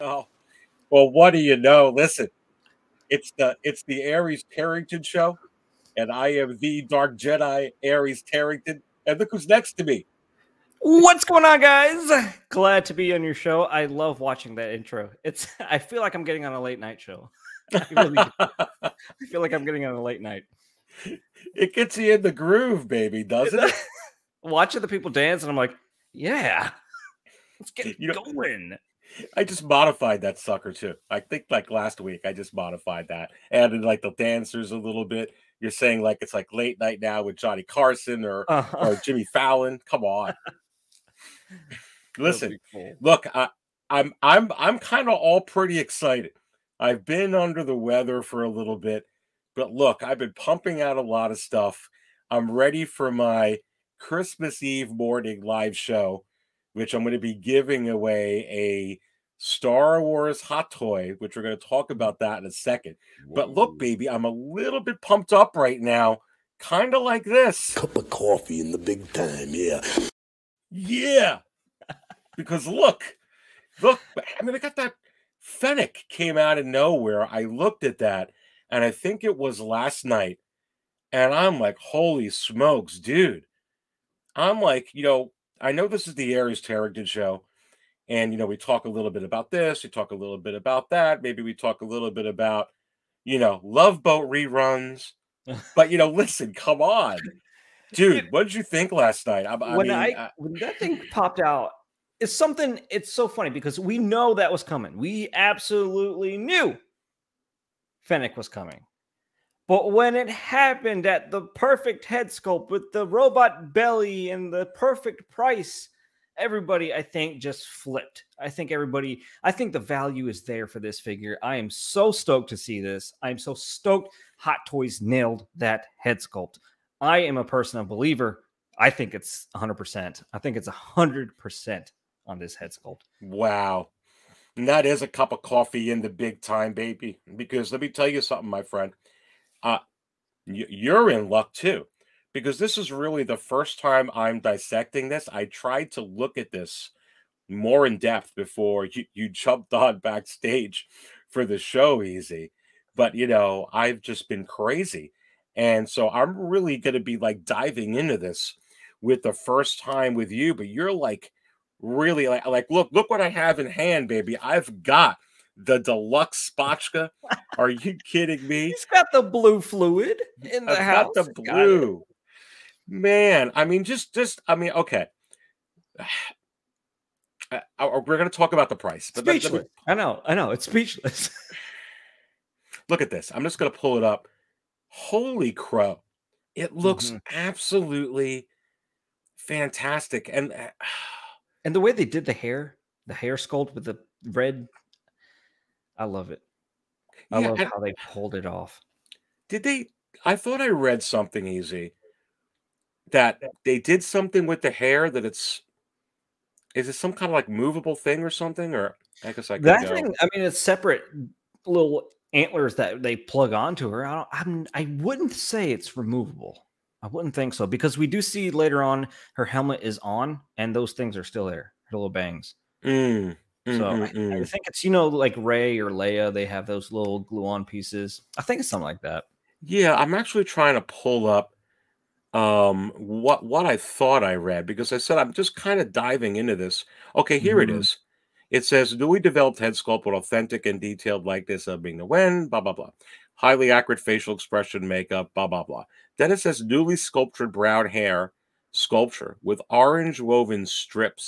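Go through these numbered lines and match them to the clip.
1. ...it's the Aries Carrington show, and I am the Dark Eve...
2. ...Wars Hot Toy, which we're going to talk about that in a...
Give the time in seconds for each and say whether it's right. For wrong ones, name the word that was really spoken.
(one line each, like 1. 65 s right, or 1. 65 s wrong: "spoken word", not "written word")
1. 3 s wrong: "Jedi", not "Eve"
2. 60 s right.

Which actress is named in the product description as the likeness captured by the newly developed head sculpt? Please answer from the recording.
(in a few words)
Ming-Na Wen.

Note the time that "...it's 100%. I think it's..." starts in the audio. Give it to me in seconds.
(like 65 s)
129 s.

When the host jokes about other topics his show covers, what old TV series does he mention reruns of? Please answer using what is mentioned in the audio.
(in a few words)
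Love Boat.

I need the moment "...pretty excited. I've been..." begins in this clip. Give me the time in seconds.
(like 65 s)
45 s.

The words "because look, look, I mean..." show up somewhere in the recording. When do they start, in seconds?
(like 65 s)
72 s.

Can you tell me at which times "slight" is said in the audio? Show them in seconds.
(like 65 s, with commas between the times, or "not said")
not said.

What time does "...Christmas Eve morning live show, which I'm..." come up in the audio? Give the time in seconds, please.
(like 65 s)
53 s.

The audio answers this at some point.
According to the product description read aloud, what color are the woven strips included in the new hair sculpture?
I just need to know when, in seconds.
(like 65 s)
249 s.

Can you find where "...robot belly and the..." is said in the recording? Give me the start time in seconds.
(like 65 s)
113 s.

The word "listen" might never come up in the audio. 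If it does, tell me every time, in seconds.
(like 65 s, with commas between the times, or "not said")
1 s, 42 s, 96 s.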